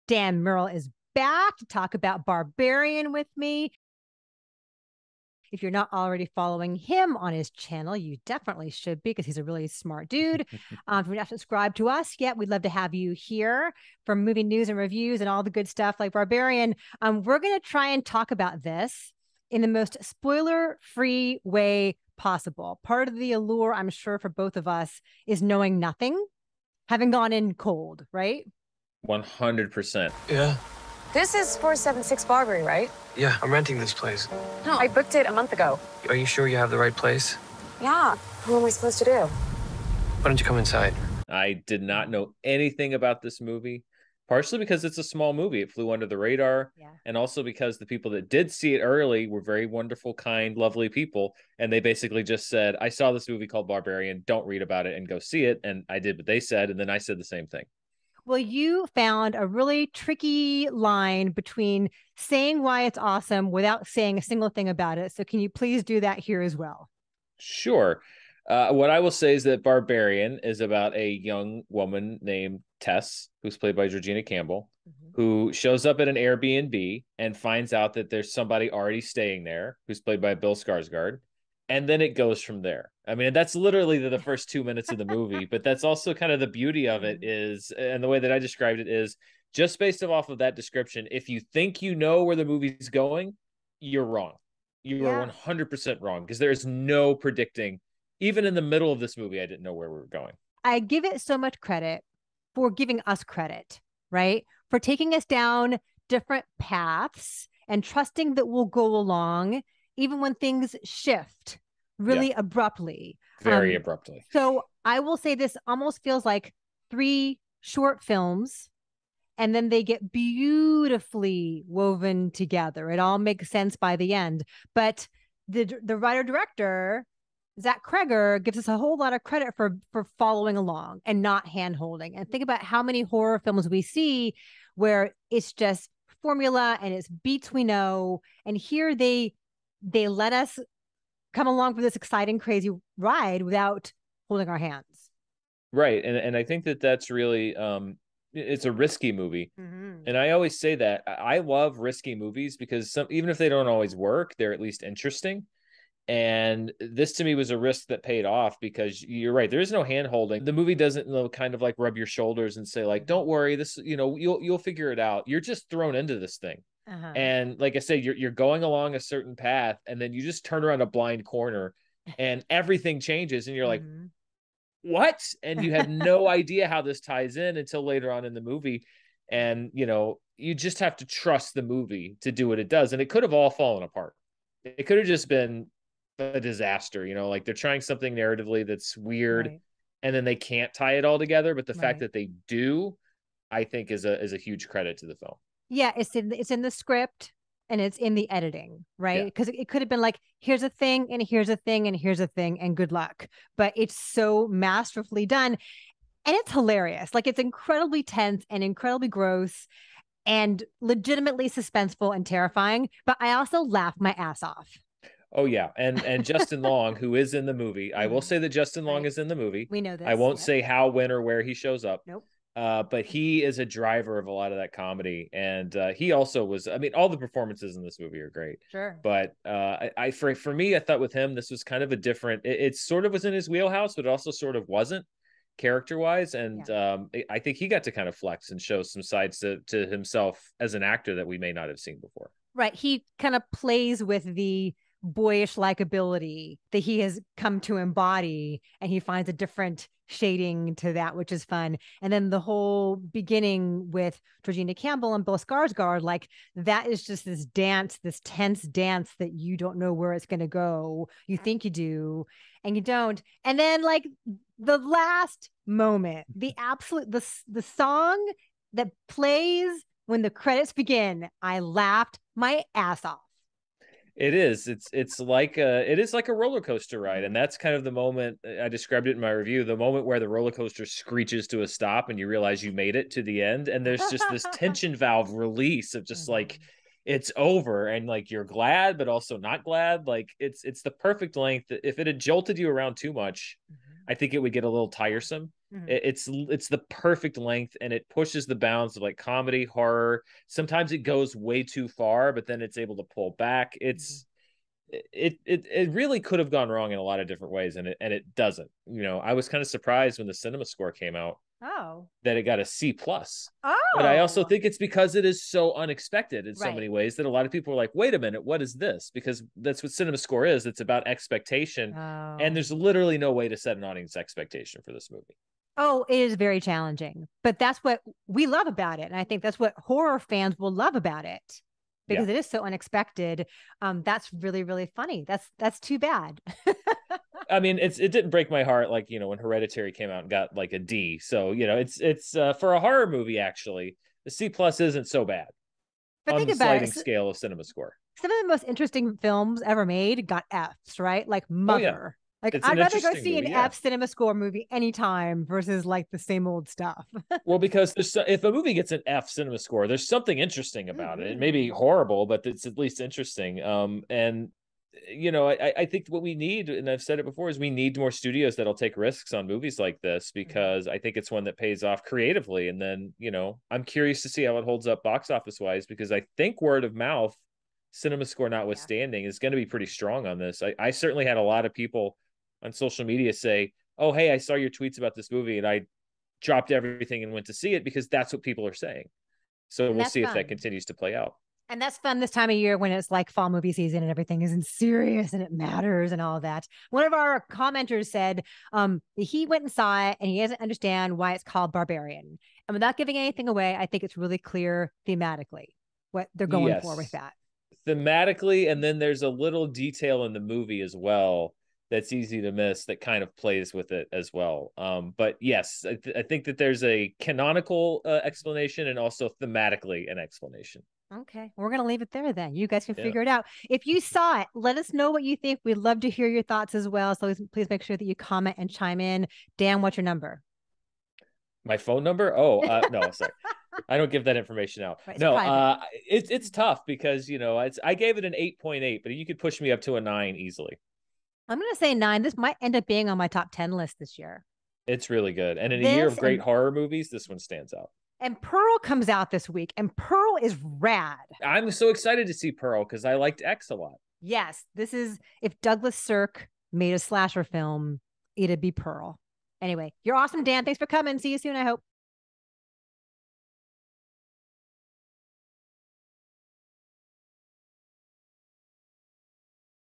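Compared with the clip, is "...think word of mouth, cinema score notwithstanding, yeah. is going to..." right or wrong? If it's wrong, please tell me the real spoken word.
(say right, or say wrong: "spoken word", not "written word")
right.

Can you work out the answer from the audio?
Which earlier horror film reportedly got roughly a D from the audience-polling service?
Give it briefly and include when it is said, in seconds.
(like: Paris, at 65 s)
Hereditary, at 339 s.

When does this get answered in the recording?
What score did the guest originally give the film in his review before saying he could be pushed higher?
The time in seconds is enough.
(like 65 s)
438 s.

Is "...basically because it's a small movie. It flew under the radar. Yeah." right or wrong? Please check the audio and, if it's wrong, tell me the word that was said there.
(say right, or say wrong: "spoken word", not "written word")
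wrong: "partially", not "basically".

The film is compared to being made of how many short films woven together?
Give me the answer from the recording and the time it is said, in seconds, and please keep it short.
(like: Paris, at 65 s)
3, at 116 s.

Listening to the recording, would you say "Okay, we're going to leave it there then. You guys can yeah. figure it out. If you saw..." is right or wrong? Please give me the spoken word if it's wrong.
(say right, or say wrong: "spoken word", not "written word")
right.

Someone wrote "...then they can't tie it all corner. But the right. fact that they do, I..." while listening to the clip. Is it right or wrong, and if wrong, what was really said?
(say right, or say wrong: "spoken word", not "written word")
wrong: "together", not "corner".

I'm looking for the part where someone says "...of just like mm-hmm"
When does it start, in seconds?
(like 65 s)
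285 s.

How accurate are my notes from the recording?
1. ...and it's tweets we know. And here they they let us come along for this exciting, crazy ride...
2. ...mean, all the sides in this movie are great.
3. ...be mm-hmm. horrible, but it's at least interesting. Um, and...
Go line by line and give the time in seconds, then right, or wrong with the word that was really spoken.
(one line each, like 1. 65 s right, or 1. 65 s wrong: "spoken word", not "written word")
1. 136 s wrong: "beats", not "tweets"
2. 226 s wrong: "performances", not "sides"
3. 361 s right.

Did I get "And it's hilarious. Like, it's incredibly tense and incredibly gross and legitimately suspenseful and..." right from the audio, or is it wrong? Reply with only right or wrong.
right.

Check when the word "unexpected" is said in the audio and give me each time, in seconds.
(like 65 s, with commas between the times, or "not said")
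315 s, 332 s.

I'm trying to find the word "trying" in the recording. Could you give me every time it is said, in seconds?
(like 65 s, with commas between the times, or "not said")
187 s.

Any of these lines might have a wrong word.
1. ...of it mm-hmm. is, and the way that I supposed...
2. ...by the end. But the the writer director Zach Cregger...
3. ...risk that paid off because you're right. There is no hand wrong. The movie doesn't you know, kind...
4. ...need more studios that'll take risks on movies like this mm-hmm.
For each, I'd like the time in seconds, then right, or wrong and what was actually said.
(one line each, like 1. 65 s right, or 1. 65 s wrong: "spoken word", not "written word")
1. 86 s wrong: "described", not "supposed"
2. 123 s right
3. 157 s wrong: "holding", not "wrong"
4. 367 s right.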